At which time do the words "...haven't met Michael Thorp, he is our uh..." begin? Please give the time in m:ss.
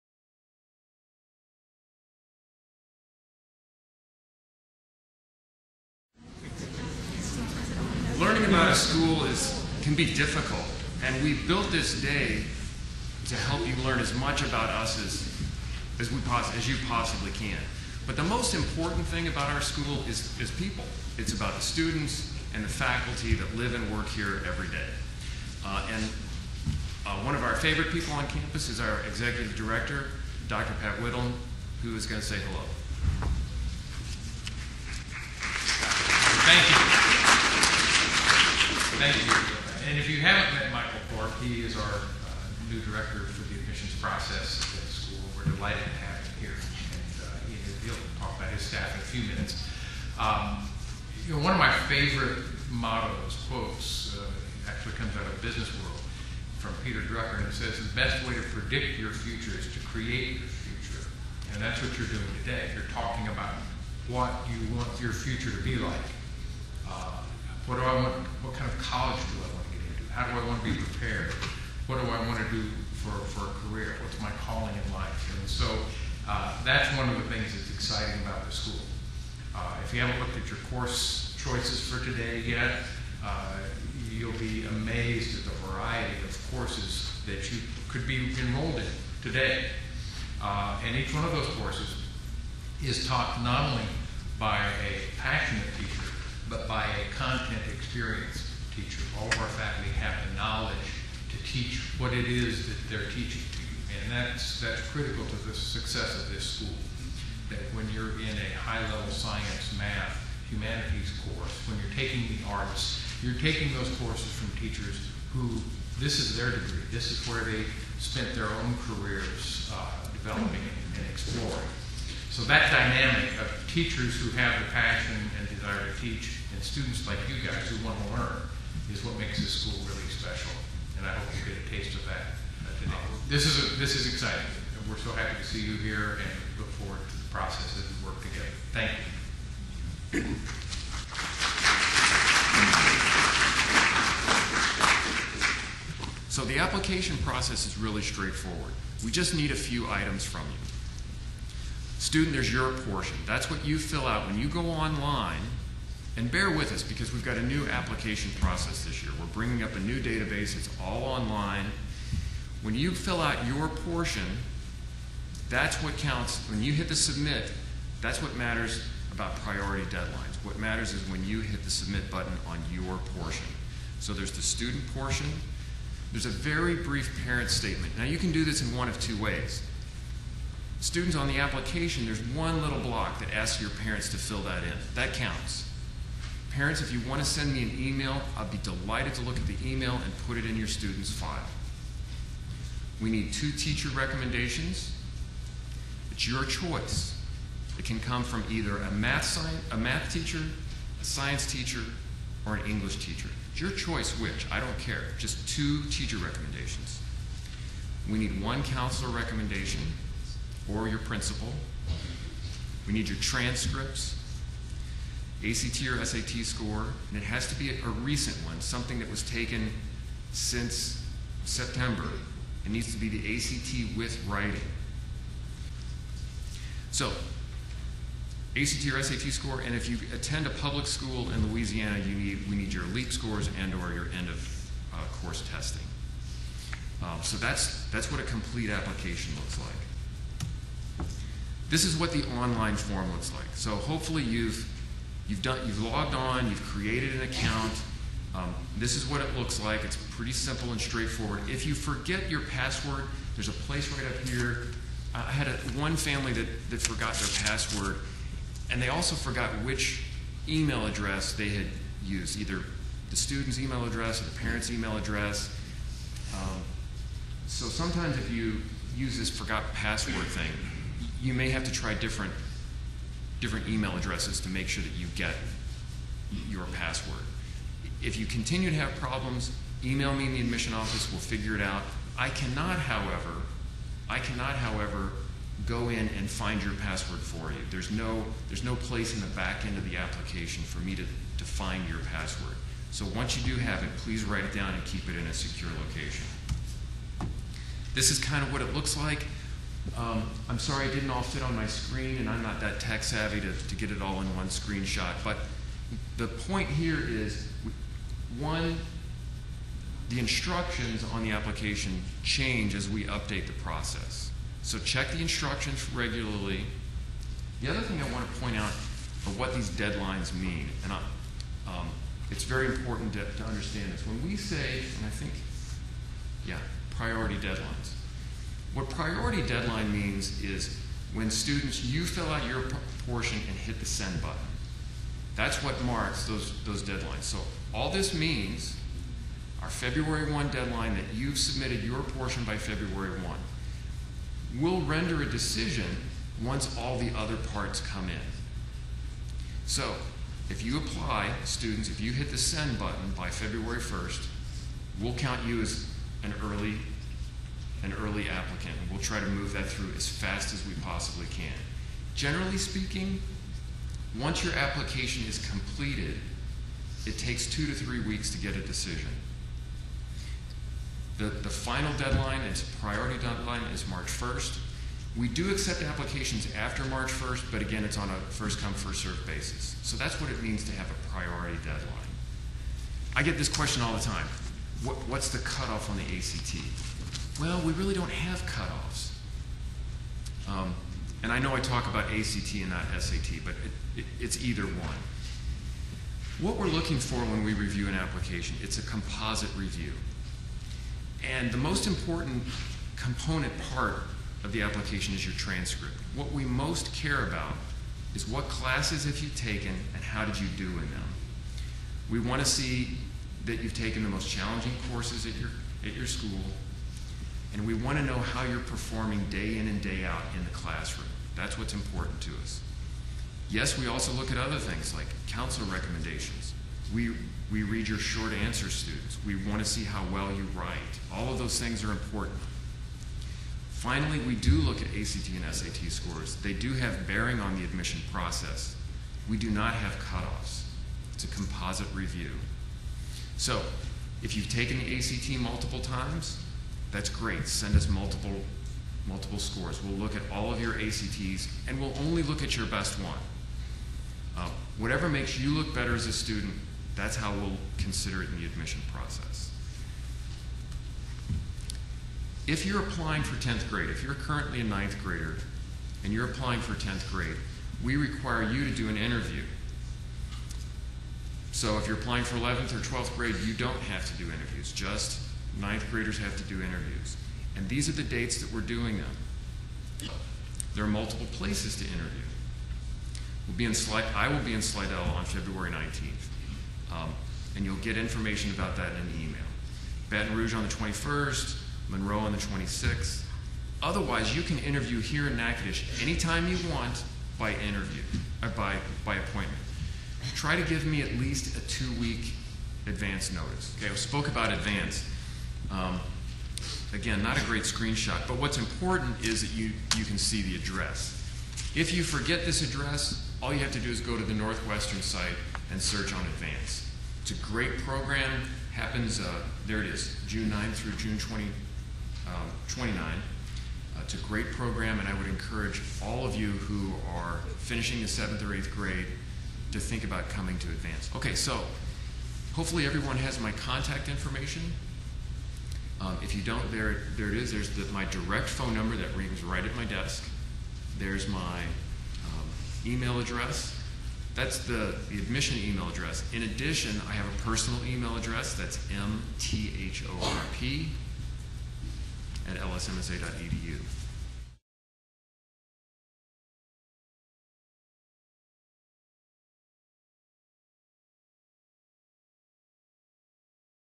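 0:40.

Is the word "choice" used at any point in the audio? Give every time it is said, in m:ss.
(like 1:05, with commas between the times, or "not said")
1:21, 3:16, 3:23.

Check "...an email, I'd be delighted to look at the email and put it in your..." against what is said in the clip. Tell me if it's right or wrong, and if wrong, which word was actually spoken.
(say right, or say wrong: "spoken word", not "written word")
right.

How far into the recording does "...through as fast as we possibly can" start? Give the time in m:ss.
5:59.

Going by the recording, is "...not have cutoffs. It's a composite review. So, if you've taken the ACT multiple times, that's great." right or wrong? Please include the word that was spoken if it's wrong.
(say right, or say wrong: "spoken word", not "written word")
right.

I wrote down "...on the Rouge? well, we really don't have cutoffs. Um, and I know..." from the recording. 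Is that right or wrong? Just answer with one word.
wrong.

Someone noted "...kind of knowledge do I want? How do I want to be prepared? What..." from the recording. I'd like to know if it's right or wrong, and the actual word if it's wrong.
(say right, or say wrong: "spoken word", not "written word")
wrong: "college", not "knowledge".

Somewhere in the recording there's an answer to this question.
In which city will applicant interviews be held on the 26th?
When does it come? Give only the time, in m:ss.
8:11.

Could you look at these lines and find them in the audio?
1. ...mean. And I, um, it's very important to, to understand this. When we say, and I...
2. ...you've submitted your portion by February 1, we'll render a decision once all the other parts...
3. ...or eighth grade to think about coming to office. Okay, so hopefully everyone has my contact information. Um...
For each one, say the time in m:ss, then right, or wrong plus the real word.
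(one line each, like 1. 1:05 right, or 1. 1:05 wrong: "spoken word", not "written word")
1. 5:20 right
2. 5:41 right
3. 8:48 wrong: "advance", not "office".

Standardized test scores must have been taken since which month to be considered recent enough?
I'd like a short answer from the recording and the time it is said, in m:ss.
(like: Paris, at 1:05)
September, at 3:41.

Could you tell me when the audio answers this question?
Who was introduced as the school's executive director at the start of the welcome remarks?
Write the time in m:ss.
0:30.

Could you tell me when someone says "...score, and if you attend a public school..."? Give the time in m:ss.
3:49.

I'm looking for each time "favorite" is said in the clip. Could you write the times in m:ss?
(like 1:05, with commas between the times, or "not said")
0:27, 0:51.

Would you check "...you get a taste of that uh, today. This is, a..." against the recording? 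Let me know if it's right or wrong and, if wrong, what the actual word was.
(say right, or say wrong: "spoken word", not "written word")
right.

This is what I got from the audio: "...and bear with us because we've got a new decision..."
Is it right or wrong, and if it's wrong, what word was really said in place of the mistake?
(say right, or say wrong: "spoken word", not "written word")
wrong: "application", not "decision".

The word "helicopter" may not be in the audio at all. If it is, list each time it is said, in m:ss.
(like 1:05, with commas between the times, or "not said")
not said.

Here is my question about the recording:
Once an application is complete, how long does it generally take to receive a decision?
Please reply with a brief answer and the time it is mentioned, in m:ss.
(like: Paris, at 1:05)
2 to 3 weeks, at 6:07.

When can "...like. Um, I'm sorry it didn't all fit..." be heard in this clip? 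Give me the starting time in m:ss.
4:58.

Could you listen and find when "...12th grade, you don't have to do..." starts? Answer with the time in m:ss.
7:52.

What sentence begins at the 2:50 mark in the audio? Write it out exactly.
What matters is when you hit the submit button on your portion.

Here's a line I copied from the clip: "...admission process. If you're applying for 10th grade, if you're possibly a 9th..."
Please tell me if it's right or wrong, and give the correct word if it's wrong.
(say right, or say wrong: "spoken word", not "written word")
wrong: "currently", not "possibly".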